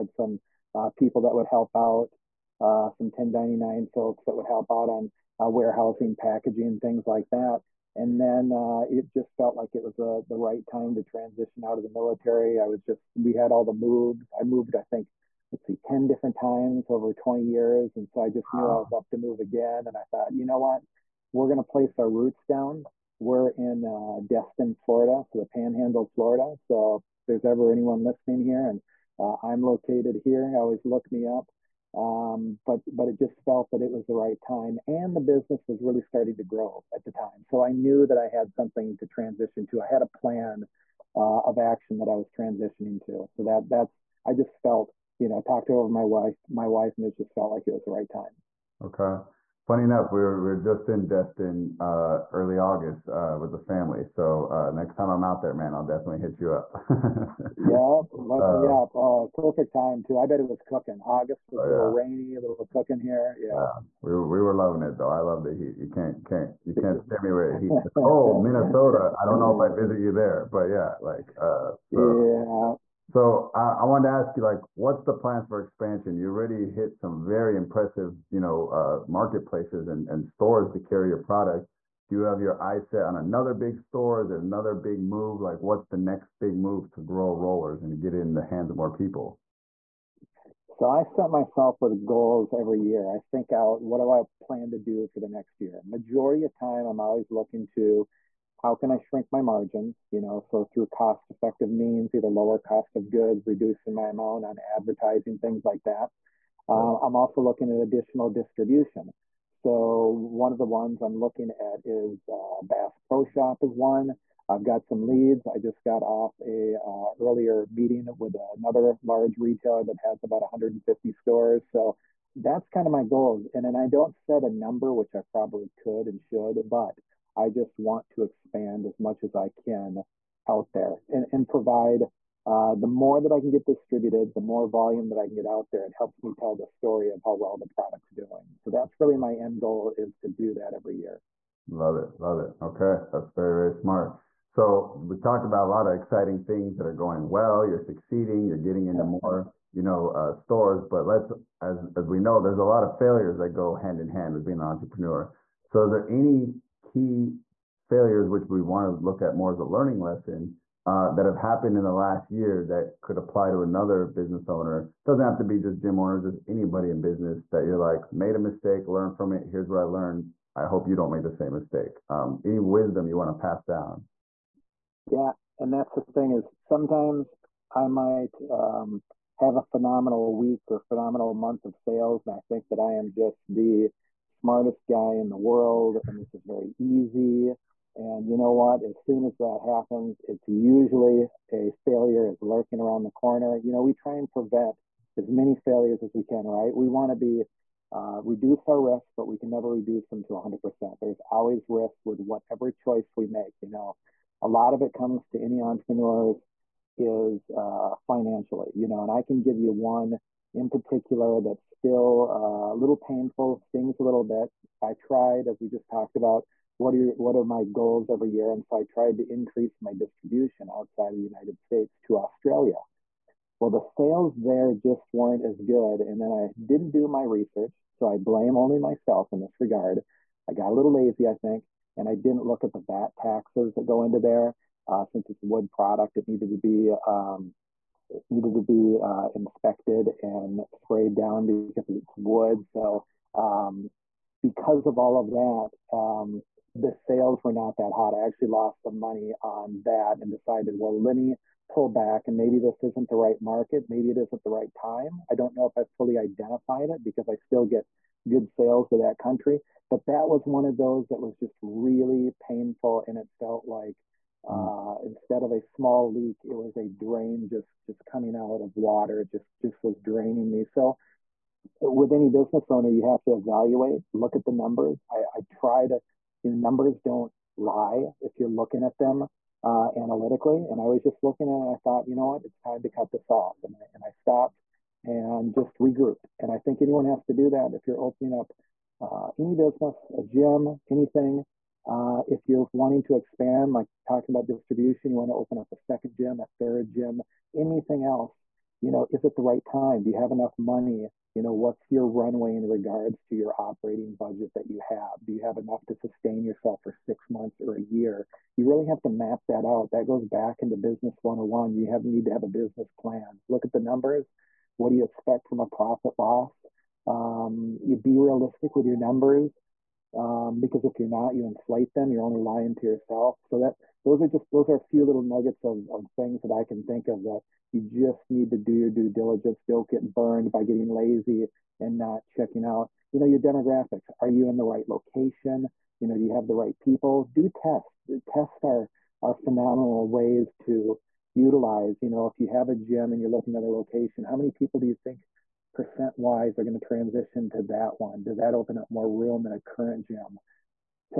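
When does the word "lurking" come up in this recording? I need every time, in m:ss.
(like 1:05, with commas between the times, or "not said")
3:12.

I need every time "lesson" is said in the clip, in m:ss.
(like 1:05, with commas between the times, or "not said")
2:39.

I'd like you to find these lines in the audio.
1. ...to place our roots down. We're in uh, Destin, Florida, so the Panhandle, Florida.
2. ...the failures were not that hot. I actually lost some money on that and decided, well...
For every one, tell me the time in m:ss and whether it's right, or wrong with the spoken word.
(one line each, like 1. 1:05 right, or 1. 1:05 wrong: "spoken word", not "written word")
1. 0:21 right
2. 4:06 wrong: "sales", not "failures".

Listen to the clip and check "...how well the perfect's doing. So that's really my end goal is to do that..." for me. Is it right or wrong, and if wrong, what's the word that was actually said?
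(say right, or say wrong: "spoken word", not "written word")
wrong: "product", not "perfect".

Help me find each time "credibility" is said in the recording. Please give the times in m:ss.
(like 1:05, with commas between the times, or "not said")
not said.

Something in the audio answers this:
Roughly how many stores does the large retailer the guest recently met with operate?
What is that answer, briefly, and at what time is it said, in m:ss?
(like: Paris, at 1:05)
150, at 2:00.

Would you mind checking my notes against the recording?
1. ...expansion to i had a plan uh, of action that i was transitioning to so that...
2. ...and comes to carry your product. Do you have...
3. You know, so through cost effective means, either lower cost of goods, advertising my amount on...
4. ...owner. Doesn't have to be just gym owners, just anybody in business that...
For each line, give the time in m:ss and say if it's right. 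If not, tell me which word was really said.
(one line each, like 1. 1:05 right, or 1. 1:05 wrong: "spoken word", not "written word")
1. 0:39 wrong: "transition", not "expansion"
2. 1:20 wrong: "stores", not "comes"
3. 1:40 wrong: "reducing", not "advertising"
4. 2:44 right.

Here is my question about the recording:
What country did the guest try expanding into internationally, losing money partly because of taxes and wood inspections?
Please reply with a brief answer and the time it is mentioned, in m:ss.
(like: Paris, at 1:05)
Australia, at 3:42.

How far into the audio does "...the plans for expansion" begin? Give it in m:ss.
1:15.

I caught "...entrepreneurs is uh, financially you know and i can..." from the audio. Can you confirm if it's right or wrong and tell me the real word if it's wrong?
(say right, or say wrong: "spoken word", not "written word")
right.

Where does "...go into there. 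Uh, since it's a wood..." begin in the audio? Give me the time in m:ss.
3:53.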